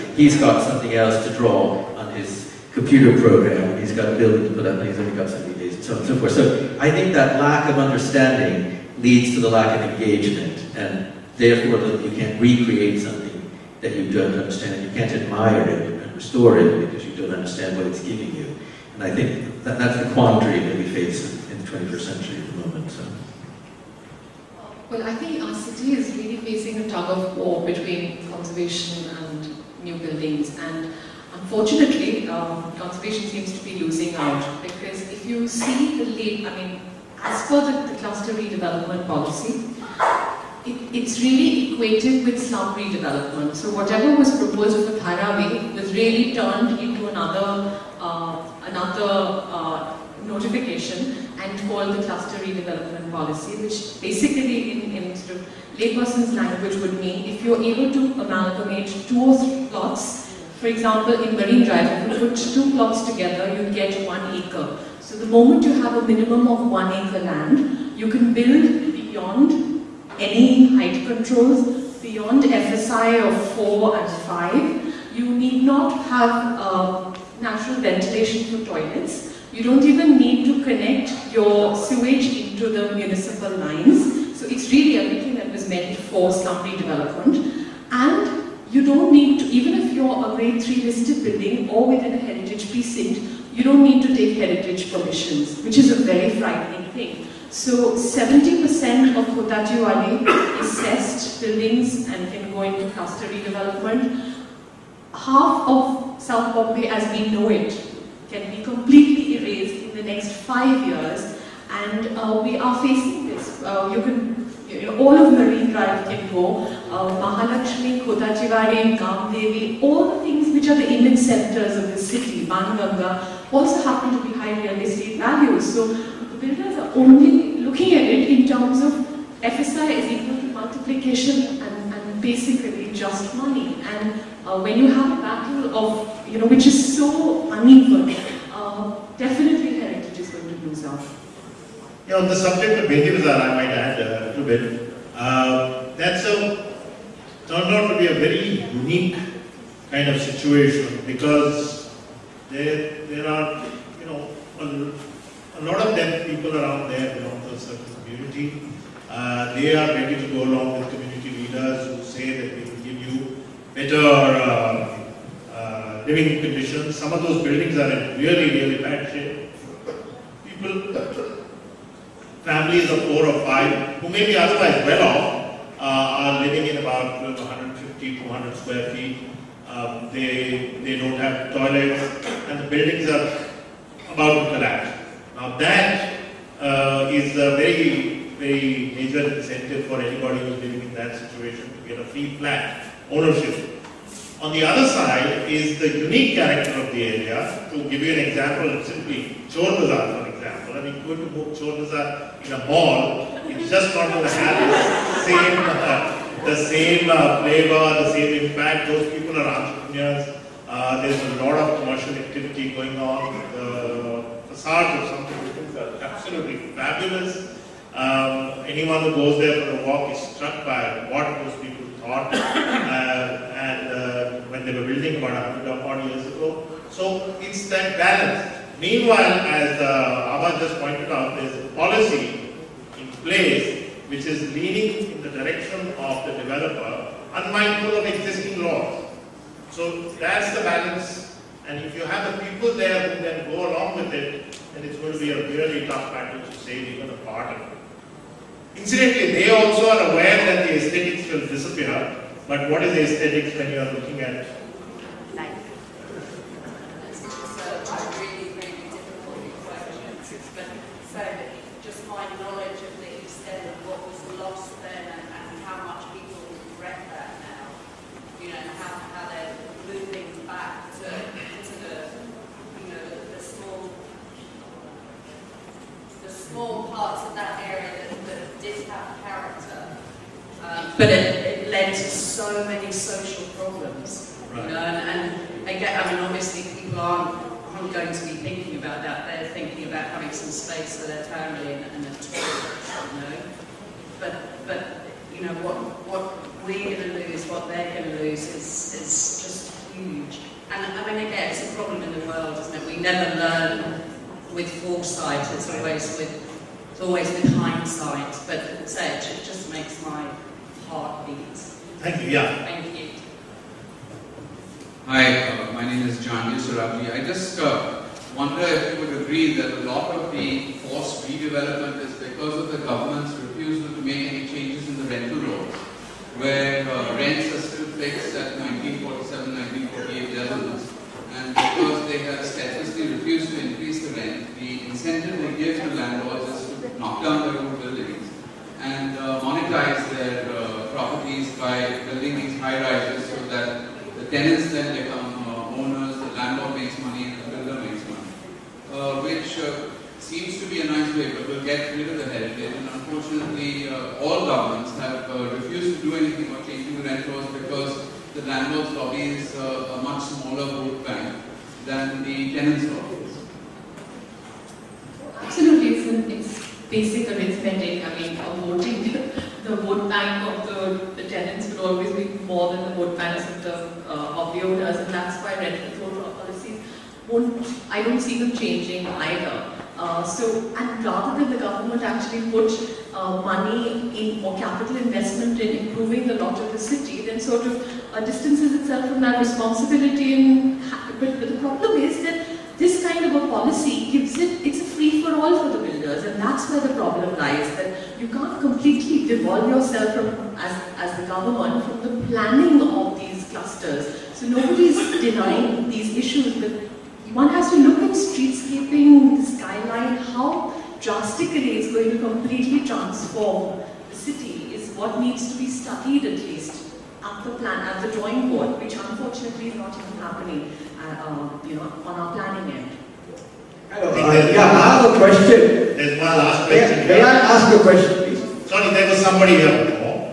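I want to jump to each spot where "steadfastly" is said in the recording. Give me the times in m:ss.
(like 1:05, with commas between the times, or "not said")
5:32.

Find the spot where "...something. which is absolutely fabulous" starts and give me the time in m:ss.
3:35.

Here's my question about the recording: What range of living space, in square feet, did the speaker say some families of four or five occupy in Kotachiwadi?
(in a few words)
150 to 200 square feet.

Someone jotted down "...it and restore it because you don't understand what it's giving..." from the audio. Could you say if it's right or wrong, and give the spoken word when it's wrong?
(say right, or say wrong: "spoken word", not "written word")
right.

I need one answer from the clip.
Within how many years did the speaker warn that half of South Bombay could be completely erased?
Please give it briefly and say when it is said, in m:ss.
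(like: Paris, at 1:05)
5 years, at 1:50.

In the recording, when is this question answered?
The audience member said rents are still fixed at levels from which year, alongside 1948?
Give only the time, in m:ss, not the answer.
5:28.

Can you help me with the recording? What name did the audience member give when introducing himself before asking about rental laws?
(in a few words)
John Surabji.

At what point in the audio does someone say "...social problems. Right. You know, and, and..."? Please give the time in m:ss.
4:42.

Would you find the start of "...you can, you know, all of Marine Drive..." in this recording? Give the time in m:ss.
1:53.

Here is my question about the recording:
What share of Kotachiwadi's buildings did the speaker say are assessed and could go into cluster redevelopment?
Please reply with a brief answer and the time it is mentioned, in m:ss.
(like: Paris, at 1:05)
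70%, at 1:37.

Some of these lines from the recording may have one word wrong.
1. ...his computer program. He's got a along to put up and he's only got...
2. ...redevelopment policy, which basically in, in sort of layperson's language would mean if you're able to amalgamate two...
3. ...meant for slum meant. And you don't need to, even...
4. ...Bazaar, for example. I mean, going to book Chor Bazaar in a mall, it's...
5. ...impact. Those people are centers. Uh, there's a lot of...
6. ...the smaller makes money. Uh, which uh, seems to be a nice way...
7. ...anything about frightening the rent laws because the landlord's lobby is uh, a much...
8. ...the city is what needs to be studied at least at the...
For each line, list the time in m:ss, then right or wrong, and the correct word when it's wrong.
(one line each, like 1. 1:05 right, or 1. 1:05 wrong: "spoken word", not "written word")
1. 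0:02 wrong: "building", not "along"
2. 0:52 right
3. 1:25 wrong: "redevelopment", not "meant"
4. 3:19 right
5. 3:28 wrong: "entrepreneurs", not "centers"
6. 5:47 wrong: "builder", not "smaller"
7. 5:56 wrong: "changing", not "frightening"
8. 6:54 right.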